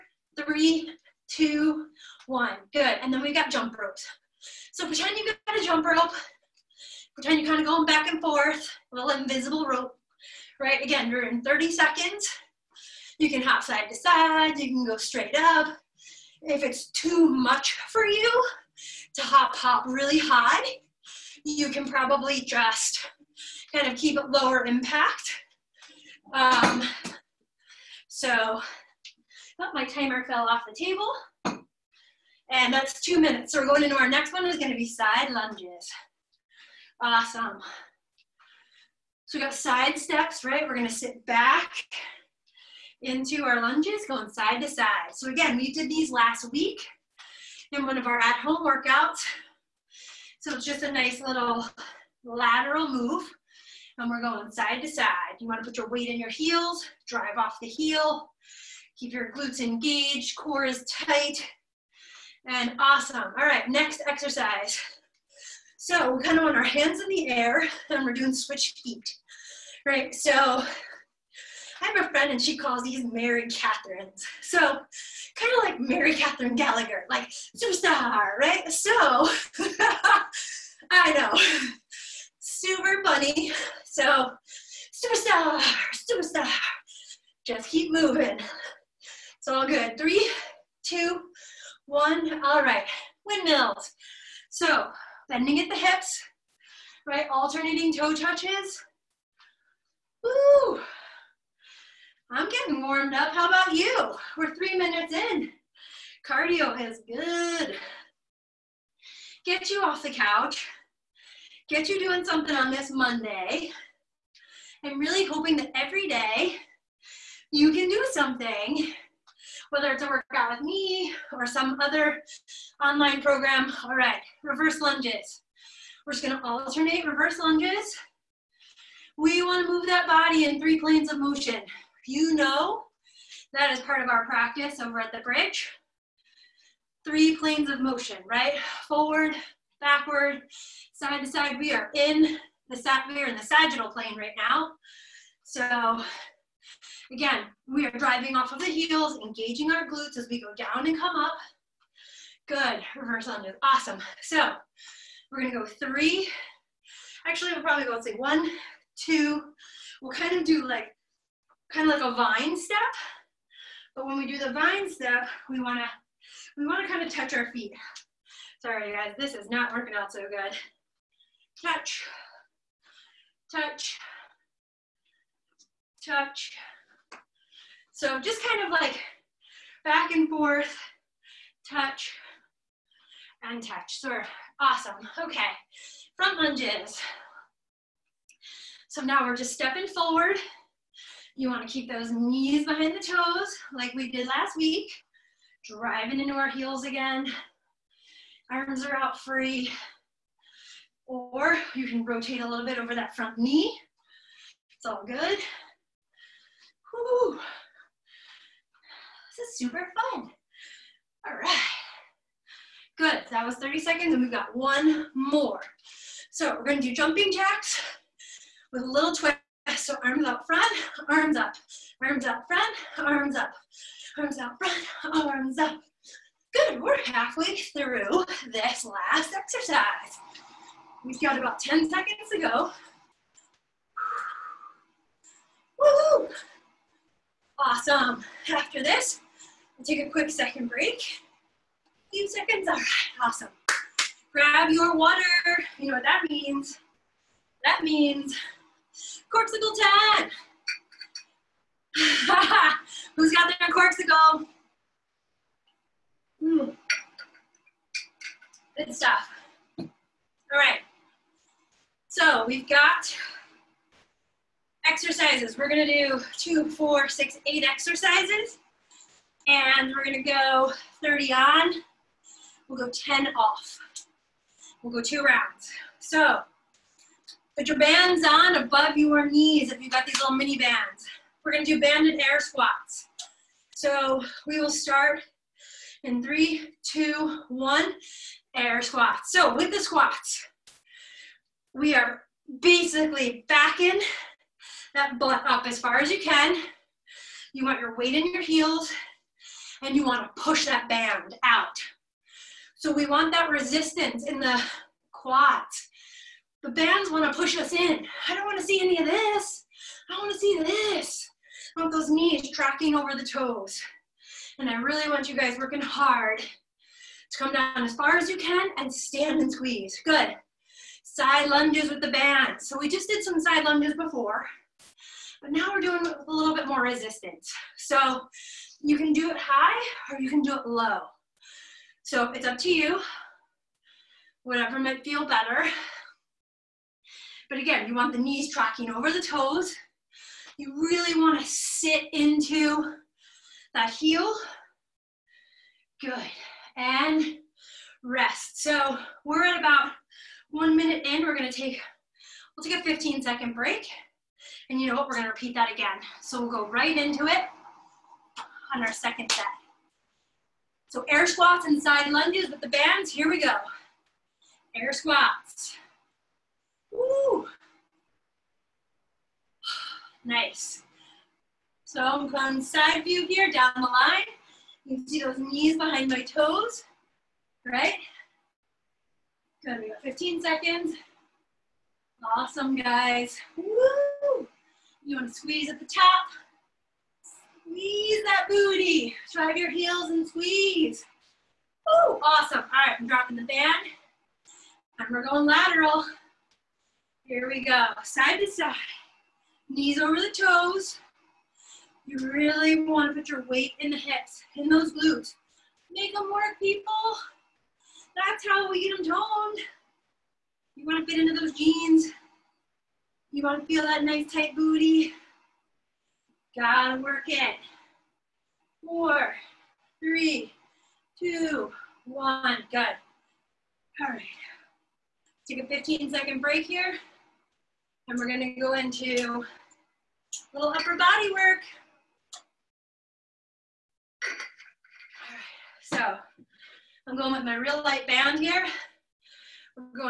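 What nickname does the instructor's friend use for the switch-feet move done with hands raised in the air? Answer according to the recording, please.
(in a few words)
Mary Catherines.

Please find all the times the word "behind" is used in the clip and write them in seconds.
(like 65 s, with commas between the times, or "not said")
192 s, 375 s.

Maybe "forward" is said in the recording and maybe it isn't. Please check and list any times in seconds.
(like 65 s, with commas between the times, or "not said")
138 s, 189 s.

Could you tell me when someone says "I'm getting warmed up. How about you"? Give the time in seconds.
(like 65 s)
102 s.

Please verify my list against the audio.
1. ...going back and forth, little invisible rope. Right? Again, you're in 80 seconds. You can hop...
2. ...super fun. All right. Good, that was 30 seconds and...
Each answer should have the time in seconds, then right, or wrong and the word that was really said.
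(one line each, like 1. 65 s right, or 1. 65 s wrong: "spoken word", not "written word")
1. 7 s wrong: "30", not "80"
2. 209 s right.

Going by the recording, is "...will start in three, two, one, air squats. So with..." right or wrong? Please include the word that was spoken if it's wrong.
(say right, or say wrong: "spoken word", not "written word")
right.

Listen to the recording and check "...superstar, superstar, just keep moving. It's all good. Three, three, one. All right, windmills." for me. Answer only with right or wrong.
wrong.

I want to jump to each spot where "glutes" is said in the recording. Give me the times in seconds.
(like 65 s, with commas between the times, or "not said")
59 s, 149 s, 404 s.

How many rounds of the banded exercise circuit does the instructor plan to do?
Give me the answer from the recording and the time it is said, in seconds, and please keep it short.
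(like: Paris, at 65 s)
2, at 275 s.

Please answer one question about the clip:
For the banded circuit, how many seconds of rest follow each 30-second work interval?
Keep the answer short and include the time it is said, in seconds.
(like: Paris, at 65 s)
10, at 272 s.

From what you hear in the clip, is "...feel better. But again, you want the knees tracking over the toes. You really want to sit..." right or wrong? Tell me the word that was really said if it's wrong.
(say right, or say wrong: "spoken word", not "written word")
right.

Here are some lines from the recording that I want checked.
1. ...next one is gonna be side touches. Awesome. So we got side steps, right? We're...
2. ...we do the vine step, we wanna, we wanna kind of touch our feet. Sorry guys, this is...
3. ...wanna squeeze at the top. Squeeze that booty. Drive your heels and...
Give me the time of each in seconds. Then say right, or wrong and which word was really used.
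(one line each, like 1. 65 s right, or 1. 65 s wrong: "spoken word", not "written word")
1. 34 s wrong: "lunges", not "touches"
2. 164 s right
3. 385 s right.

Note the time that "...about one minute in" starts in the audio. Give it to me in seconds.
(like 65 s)
349 s.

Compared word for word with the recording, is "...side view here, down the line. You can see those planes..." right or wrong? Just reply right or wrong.
wrong.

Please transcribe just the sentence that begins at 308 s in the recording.
I don't want to see any of this.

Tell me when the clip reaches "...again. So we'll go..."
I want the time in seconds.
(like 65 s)
355 s.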